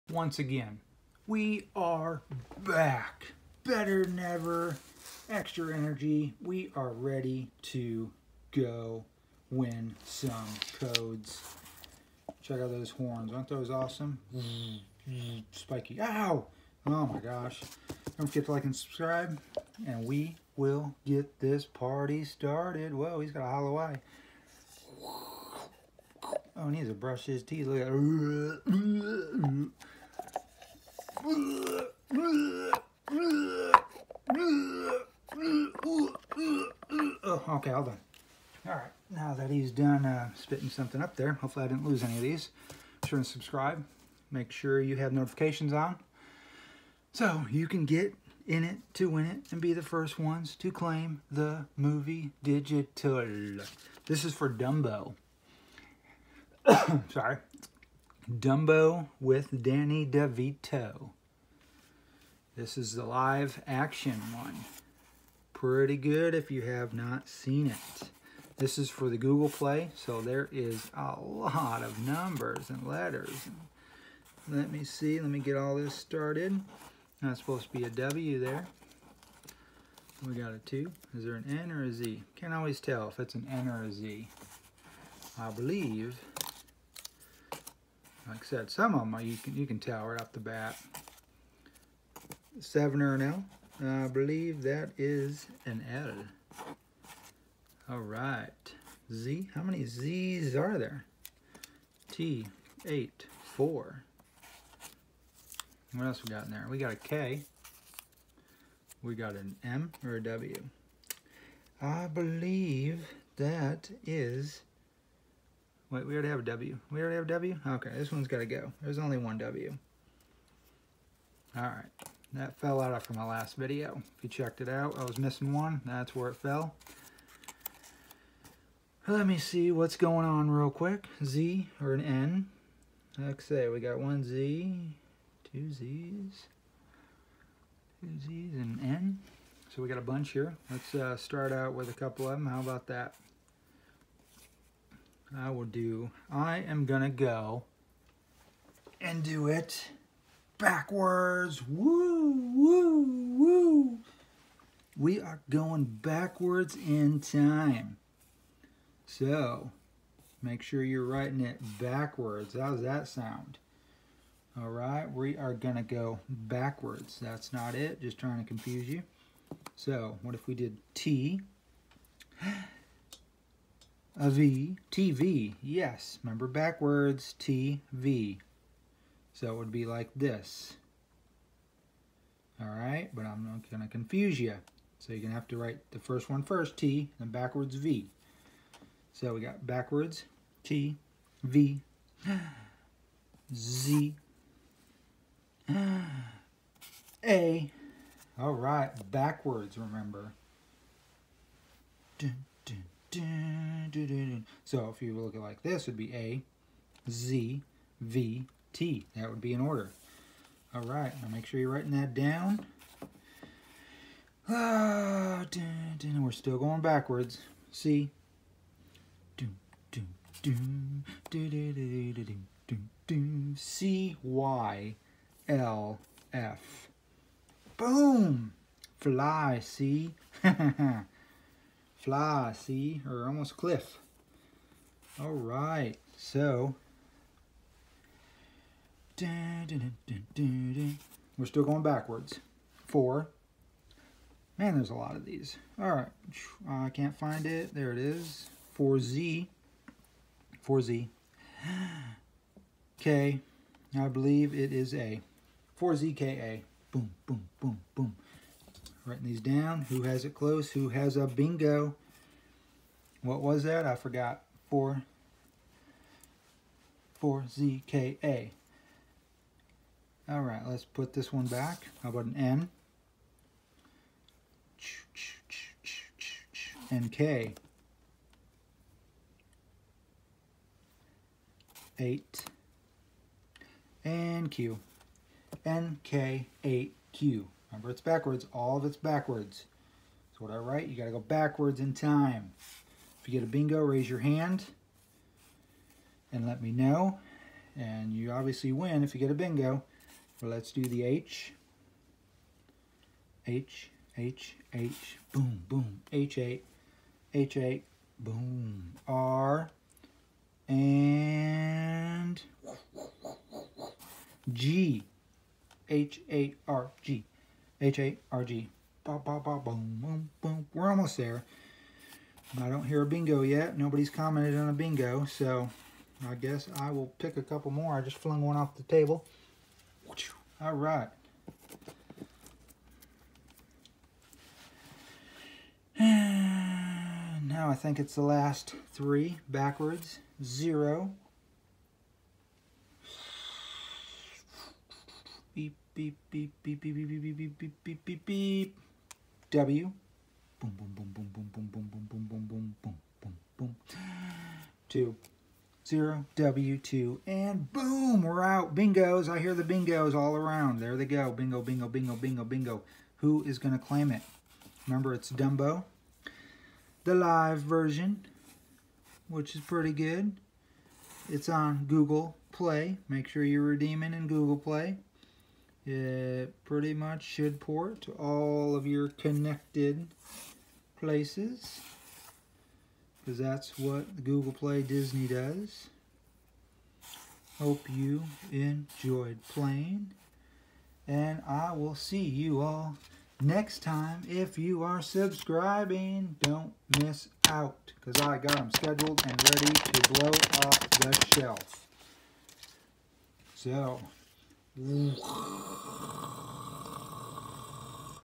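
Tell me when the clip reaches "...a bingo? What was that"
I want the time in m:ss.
4:21.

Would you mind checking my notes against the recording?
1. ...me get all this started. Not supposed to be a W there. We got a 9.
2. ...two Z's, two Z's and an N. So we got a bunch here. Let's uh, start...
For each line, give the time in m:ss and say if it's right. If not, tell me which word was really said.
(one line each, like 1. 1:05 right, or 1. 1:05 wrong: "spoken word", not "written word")
1. 1:15 wrong: "2", not "9"
2. 2:15 right.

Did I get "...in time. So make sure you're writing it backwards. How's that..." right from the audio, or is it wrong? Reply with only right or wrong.
right.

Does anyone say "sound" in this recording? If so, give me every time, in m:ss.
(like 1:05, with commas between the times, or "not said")
2:43.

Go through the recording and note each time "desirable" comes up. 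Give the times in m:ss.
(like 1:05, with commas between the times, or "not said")
not said.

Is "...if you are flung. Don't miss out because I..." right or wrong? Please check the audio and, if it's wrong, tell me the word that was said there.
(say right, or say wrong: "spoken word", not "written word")
wrong: "subscribing", not "flung".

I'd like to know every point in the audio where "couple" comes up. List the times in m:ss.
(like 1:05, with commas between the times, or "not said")
2:21, 5:27.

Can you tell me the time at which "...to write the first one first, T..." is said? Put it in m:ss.
3:05.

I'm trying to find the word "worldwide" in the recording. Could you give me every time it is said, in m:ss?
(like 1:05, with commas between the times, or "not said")
not said.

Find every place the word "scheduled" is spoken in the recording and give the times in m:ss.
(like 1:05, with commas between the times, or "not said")
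6:38.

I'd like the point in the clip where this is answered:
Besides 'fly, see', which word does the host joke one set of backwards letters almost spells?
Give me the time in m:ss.
3:53.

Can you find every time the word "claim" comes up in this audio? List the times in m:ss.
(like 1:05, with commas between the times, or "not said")
0:50, 6:03.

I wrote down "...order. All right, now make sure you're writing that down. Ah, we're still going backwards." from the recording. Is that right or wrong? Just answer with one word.
right.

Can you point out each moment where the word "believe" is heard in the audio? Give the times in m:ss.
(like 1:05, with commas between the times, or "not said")
1:25, 1:34, 1:52, 4:14.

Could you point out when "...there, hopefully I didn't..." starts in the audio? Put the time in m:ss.
0:41.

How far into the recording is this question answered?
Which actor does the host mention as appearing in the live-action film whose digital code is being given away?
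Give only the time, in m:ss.
0:59.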